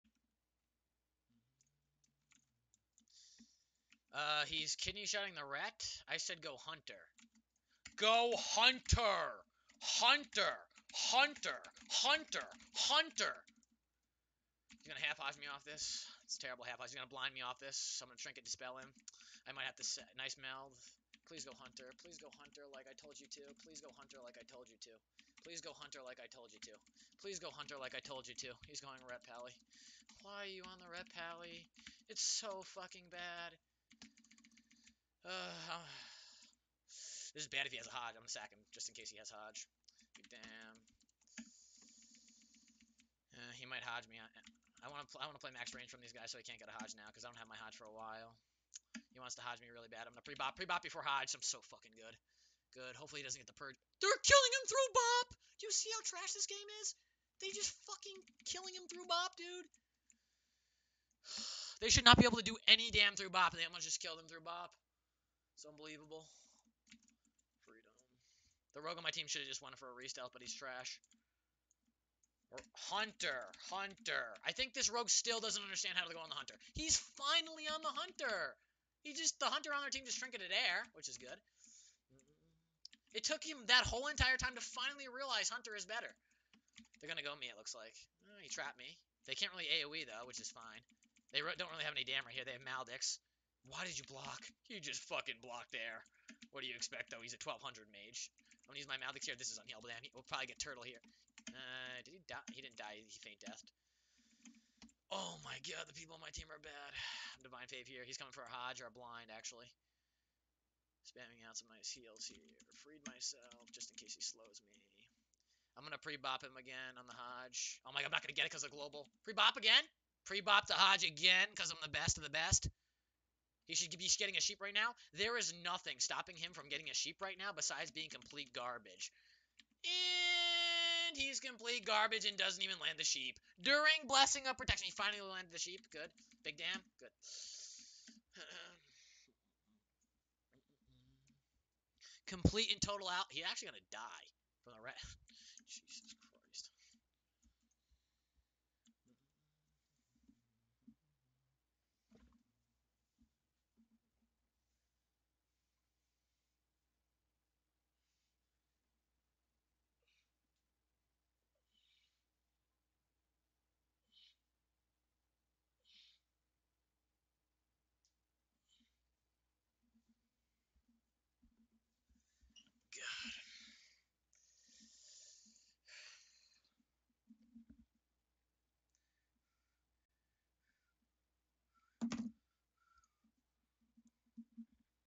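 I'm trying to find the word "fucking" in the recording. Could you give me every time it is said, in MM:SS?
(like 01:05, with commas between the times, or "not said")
00:32, 00:51, 00:57, 01:35.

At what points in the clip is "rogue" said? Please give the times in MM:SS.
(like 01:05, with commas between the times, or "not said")
01:08, 01:14.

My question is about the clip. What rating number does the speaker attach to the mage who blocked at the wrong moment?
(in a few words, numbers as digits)
1200.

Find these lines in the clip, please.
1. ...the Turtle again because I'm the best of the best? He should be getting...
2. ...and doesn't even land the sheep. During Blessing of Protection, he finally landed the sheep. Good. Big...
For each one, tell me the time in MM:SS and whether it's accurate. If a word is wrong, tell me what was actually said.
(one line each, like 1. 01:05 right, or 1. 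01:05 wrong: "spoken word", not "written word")
1. 02:00 wrong: "Hodge", not "Turtle"
2. 02:12 right.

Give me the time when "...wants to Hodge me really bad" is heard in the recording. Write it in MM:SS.
00:49.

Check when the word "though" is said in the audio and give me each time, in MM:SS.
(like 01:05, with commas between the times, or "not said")
01:30, 01:37.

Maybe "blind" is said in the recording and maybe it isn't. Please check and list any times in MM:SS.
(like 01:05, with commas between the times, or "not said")
00:17, 01:48.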